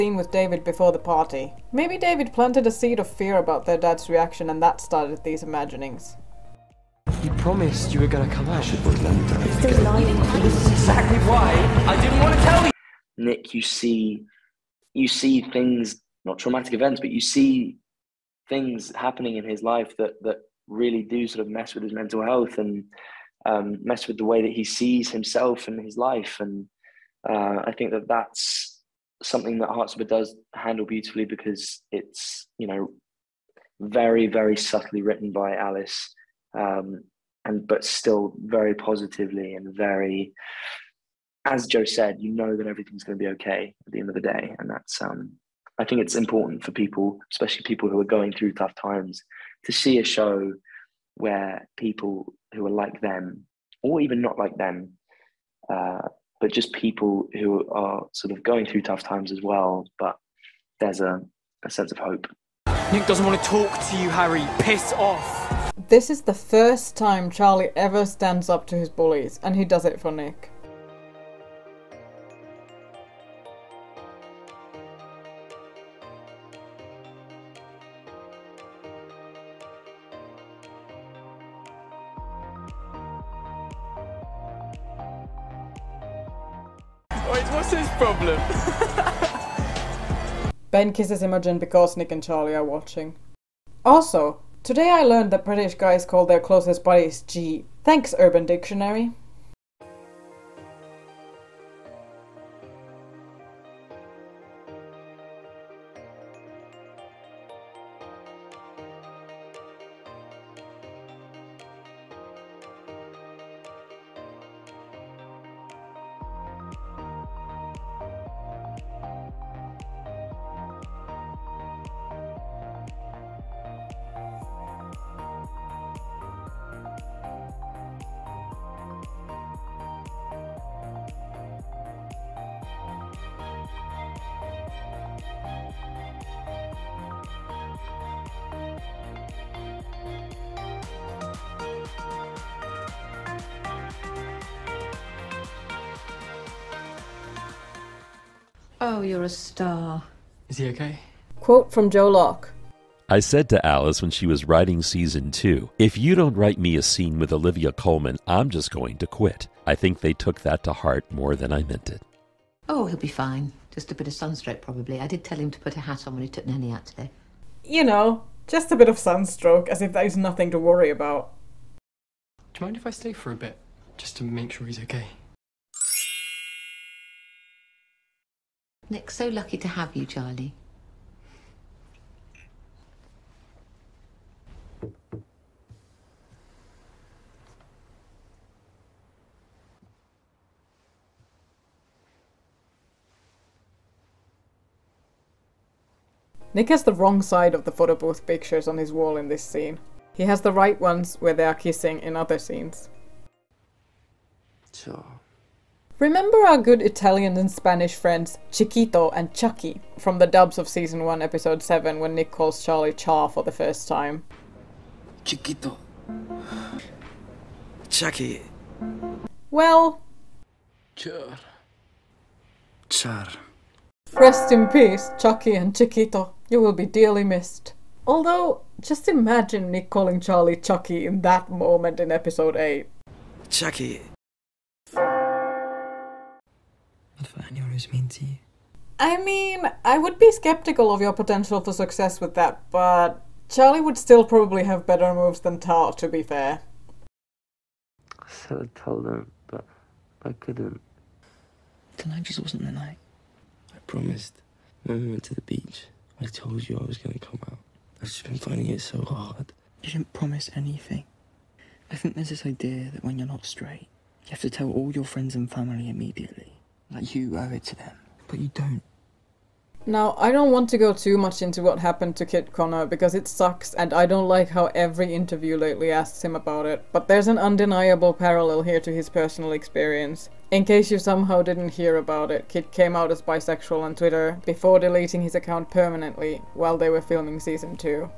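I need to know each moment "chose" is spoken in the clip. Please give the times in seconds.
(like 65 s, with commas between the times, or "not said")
not said.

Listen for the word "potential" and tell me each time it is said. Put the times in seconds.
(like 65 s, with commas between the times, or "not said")
241 s.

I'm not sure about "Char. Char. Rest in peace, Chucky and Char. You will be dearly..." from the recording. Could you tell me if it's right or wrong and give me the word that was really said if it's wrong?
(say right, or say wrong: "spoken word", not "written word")
wrong: "Chiquito", not "Char".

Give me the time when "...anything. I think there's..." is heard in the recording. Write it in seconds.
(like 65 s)
260 s.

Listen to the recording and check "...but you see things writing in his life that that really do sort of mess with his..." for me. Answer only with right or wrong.
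wrong.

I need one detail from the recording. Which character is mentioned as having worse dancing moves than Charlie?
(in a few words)
Tao.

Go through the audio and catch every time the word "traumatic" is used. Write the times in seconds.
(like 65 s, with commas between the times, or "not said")
16 s.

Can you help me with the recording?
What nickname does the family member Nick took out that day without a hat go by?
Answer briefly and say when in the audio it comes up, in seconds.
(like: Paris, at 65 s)
Nanny, at 166 s.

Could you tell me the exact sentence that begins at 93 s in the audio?
Also, Today I learned that British guys call their closest buddies G.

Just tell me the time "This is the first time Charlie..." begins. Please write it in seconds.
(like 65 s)
65 s.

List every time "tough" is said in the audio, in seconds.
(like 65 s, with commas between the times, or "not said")
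48 s, 58 s.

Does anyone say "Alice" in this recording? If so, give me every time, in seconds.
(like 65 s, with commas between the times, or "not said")
35 s, 153 s.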